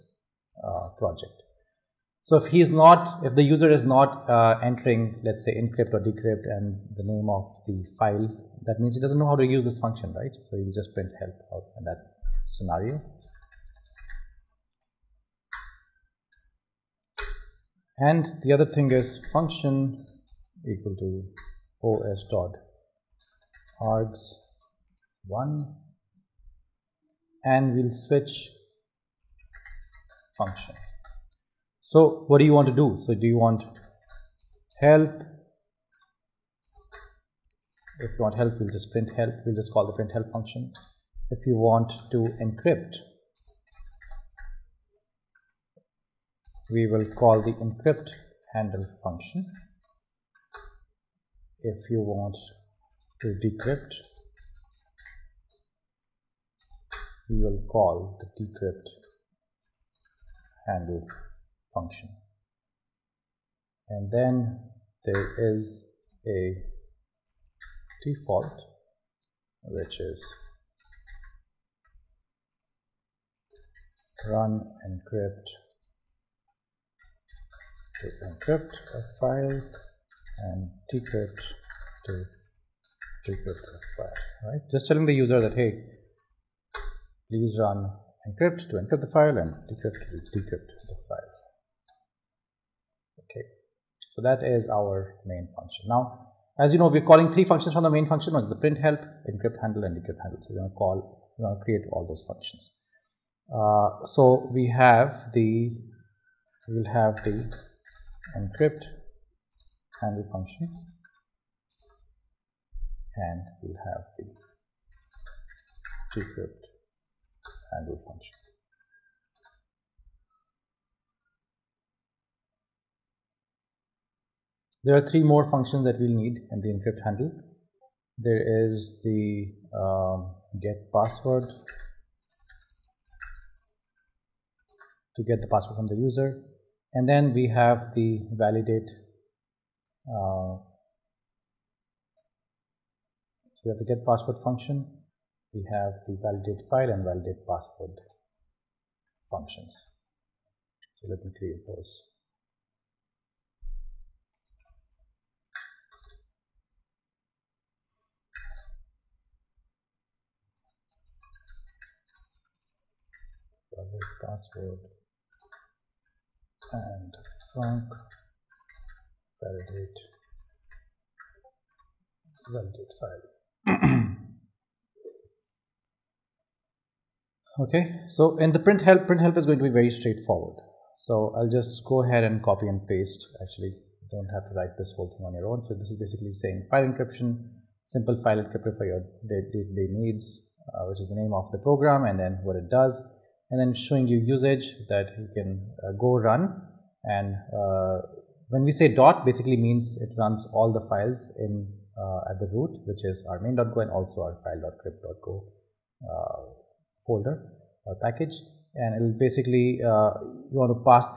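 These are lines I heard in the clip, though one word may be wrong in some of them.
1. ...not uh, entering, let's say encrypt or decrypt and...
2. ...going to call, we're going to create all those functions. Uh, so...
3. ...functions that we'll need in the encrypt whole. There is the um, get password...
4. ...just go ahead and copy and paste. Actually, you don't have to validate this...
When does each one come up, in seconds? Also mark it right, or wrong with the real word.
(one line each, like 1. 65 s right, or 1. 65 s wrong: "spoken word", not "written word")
1. 3 s right
2. 100 s right
3. 125 s wrong: "handle", not "whole"
4. 181 s wrong: "write", not "validate".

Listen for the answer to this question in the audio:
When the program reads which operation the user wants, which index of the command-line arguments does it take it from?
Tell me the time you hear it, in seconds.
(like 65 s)
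21 s.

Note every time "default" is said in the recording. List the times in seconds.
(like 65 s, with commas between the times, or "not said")
68 s.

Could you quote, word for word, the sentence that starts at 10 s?
So he will just print help out in that scenario.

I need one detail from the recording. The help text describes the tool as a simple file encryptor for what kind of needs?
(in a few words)
day-to-day needs.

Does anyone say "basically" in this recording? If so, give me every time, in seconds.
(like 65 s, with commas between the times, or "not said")
185 s, 199 s, 209 s.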